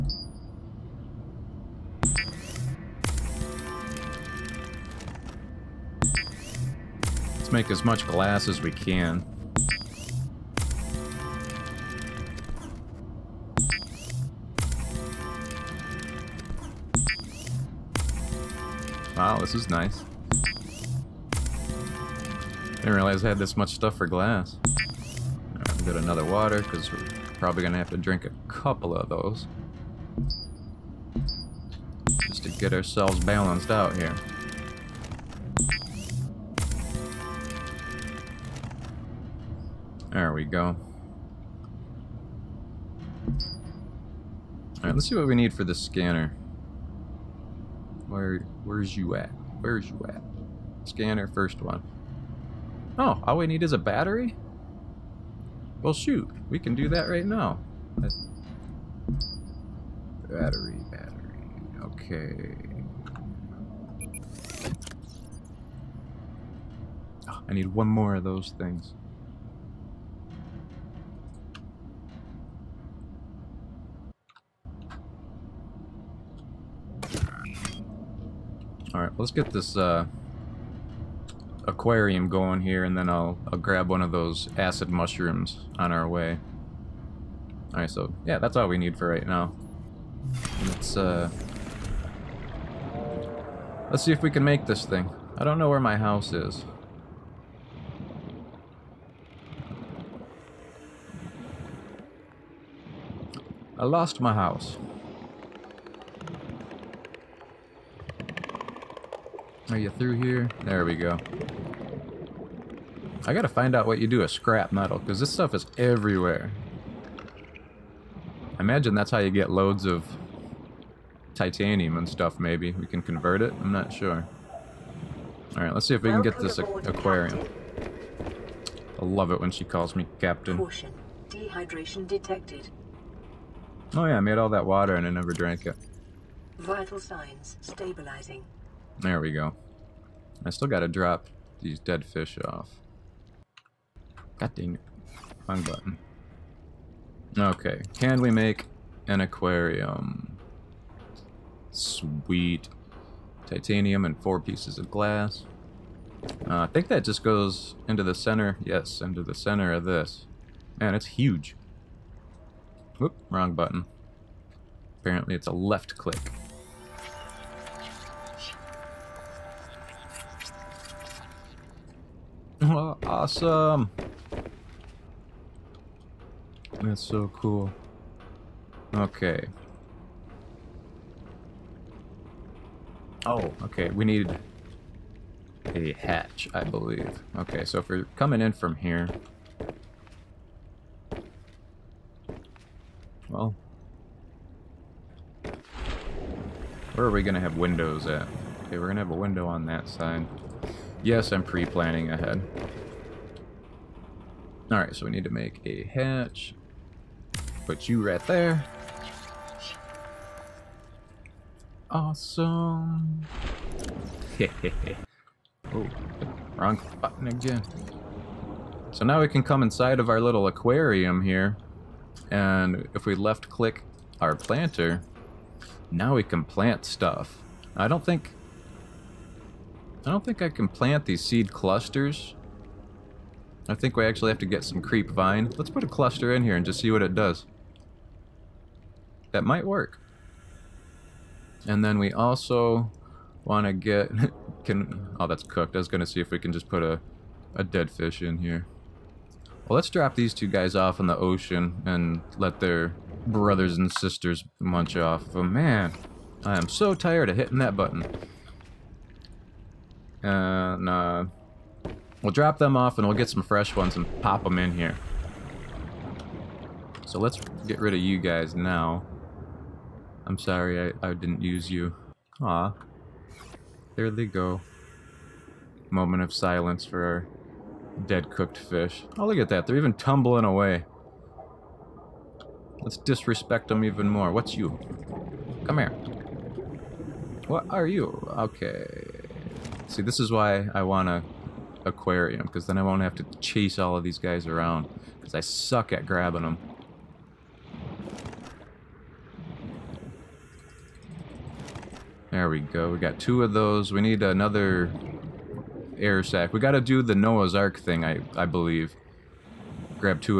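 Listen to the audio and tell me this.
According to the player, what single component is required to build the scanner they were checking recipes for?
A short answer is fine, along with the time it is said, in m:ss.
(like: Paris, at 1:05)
A battery, at 0:53.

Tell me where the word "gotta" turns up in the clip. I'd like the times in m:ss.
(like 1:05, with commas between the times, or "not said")
1:53, 2:20.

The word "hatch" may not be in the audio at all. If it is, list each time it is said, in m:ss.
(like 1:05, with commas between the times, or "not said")
3:05, 3:25.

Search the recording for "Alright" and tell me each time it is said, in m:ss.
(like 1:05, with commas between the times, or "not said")
0:44, 1:18, 1:27, 2:05, 3:24.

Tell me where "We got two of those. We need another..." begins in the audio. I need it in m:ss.
5:02.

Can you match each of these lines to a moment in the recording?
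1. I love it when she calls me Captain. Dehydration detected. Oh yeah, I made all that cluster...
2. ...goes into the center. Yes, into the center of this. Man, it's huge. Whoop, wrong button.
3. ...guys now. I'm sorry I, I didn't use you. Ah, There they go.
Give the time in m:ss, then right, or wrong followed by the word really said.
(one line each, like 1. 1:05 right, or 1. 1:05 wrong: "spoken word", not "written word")
1. 2:09 wrong: "water", not "cluster"
2. 2:37 right
3. 4:28 right.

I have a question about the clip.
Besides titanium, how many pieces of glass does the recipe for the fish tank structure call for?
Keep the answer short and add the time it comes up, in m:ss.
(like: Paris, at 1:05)
4, at 2:34.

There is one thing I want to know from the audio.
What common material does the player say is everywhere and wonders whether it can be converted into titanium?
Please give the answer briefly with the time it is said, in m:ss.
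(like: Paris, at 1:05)
Scrap metal, at 1:54.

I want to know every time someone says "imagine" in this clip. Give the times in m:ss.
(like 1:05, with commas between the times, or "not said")
1:58.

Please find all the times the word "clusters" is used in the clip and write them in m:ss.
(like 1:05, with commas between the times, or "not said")
3:51, 3:55.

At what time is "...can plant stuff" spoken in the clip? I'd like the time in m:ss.
3:46.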